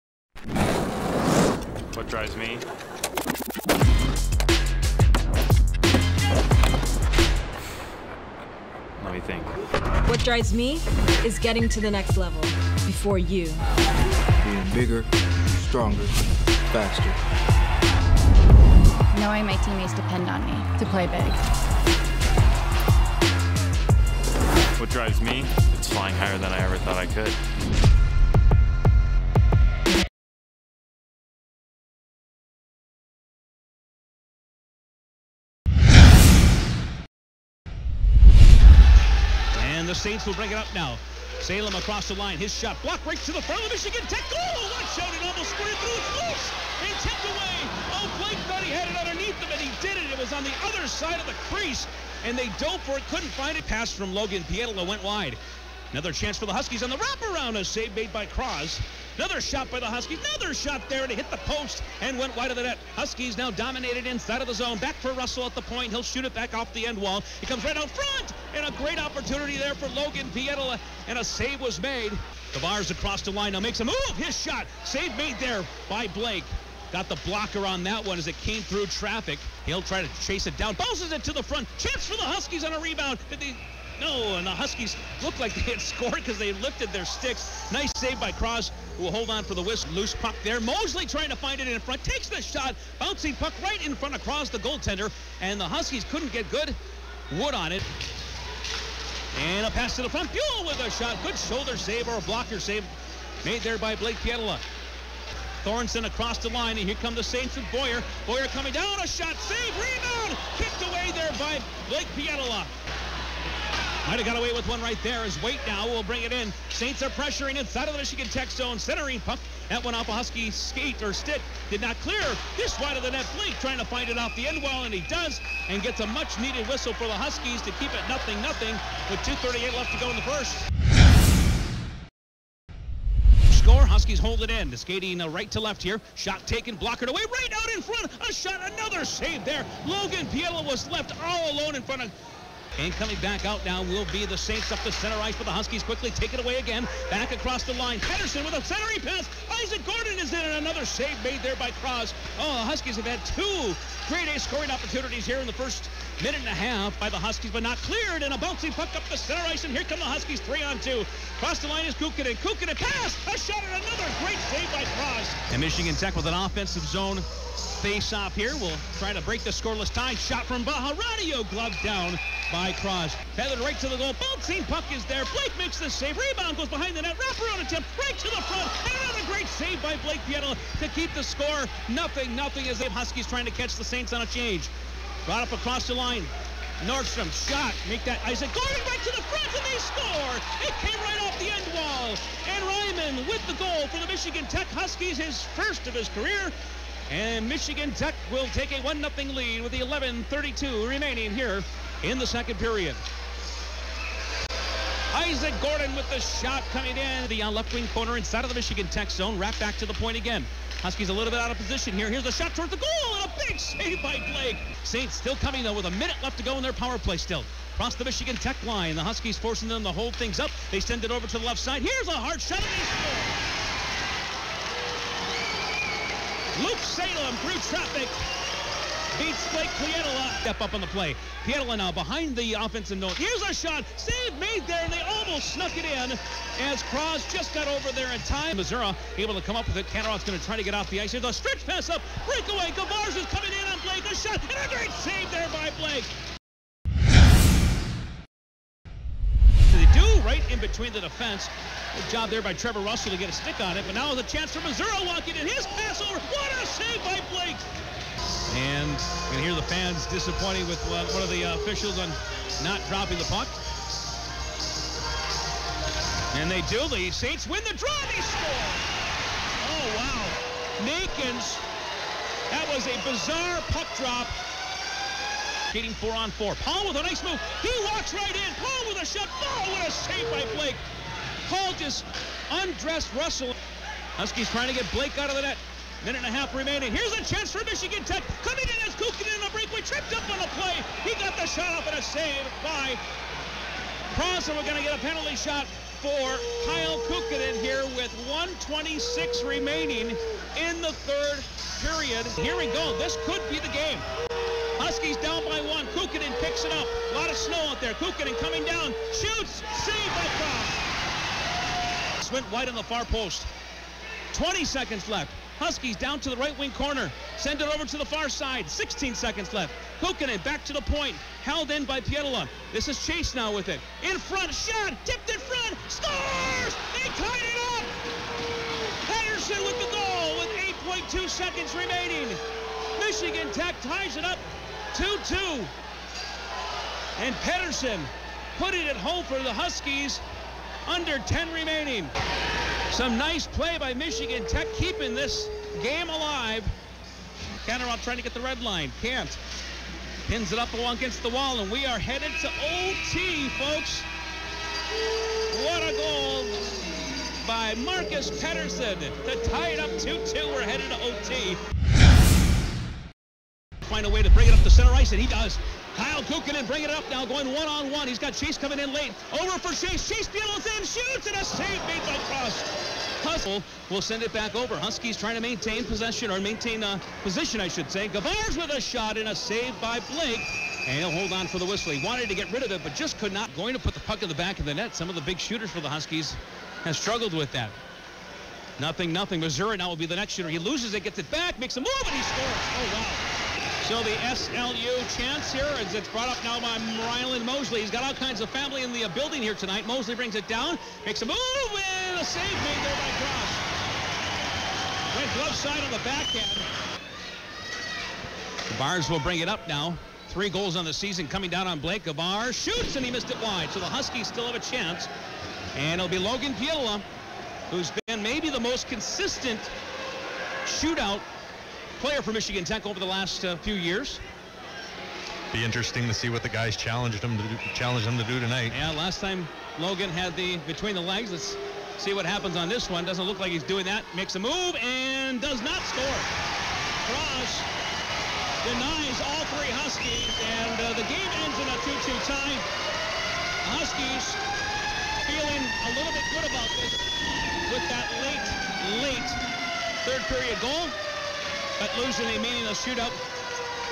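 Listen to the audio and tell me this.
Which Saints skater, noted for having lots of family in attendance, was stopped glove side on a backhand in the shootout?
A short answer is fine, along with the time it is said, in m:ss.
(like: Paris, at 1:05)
Ryland Mosley, at 6:37.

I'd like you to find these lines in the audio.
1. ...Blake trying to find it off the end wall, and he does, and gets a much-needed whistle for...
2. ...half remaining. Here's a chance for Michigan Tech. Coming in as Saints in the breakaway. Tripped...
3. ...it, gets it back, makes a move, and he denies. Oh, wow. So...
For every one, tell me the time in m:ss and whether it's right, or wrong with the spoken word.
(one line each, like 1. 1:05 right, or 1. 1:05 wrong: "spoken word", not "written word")
1. 2:03 right
2. 4:46 wrong: "Kukin", not "Saints"
3. 6:30 wrong: "scores", not "denies".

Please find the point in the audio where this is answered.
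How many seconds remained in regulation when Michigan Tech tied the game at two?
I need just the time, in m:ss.
5:31.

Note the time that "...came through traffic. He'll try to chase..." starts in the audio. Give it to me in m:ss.
1:18.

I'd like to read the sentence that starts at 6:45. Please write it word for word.
Went glove side on the backhand.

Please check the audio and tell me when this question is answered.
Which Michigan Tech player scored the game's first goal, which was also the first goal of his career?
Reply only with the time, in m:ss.
3:12.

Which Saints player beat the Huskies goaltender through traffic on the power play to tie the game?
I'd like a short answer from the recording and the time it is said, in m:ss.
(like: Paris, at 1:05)
Luke Salem, at 3:46.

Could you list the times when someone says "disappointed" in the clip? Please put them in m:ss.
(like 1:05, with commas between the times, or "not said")
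4:20.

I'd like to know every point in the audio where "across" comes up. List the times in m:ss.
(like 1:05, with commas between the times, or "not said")
0:41, 1:12, 1:46, 2:27, 2:41, 3:05, 3:37.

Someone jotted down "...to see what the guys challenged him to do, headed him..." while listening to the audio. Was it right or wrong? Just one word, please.
wrong.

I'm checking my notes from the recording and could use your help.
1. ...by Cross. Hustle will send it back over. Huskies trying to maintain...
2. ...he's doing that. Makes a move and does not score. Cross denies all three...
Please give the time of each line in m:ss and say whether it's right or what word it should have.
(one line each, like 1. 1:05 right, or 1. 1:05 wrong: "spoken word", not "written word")
1. 6:12 right
2. 7:13 right.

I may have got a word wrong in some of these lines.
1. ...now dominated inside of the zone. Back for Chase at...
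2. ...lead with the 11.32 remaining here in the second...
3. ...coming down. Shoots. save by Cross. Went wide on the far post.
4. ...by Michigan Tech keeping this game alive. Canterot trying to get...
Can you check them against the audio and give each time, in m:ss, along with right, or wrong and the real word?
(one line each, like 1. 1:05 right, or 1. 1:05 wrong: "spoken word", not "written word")
1. 1:03 wrong: "Russell", not "Chase"
2. 3:19 right
3. 5:08 right
4. 5:43 right.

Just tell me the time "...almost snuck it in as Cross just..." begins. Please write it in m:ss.
3:55.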